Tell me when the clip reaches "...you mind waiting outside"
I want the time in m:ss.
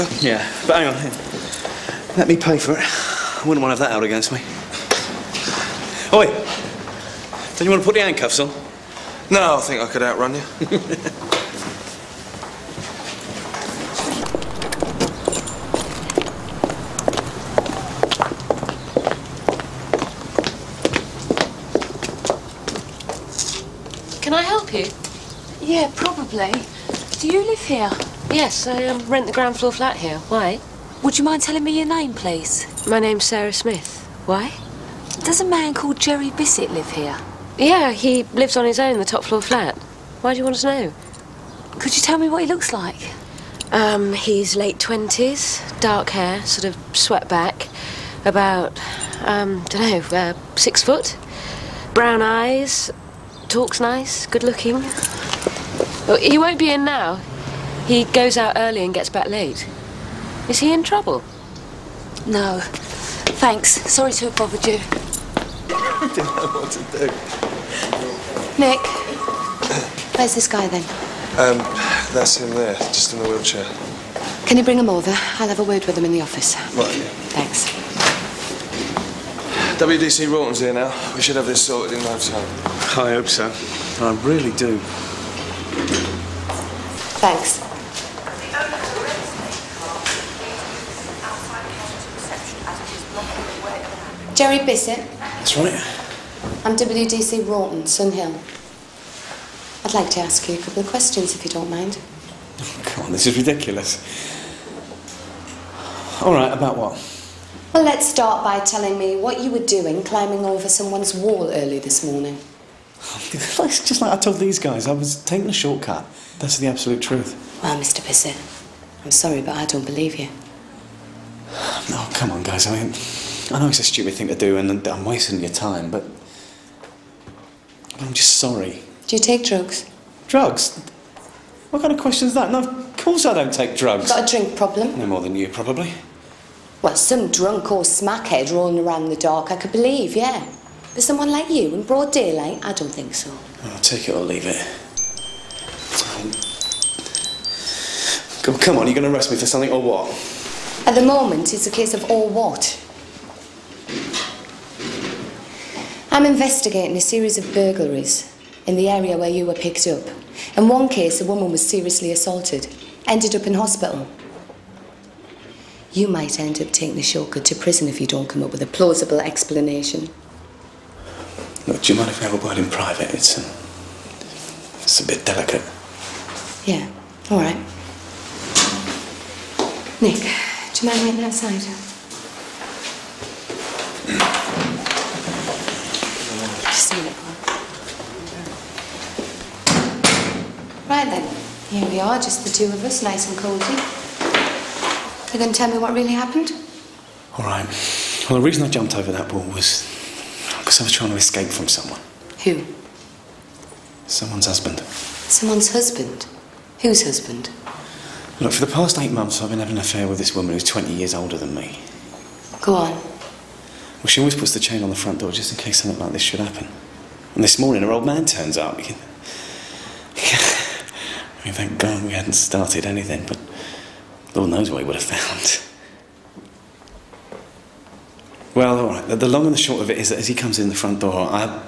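3:00.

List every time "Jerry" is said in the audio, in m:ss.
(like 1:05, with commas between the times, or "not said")
0:35, 1:34.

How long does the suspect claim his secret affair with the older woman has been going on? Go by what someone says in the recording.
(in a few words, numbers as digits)
8 months.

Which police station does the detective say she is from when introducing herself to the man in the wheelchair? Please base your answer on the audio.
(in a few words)
Sunhill.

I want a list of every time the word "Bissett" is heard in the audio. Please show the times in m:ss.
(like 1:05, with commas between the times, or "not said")
0:36, 1:34, 1:58.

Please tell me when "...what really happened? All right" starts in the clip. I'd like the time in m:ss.
3:15.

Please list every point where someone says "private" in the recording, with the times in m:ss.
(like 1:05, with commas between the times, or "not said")
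2:52.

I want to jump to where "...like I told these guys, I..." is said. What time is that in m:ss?
1:54.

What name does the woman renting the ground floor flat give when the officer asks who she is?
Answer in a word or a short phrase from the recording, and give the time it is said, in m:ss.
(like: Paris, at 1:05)
Sarah Smith, at 0:33.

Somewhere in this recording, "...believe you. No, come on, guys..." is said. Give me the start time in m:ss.
1:59.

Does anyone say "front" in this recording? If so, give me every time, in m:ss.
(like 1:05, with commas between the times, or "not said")
3:34, 3:50.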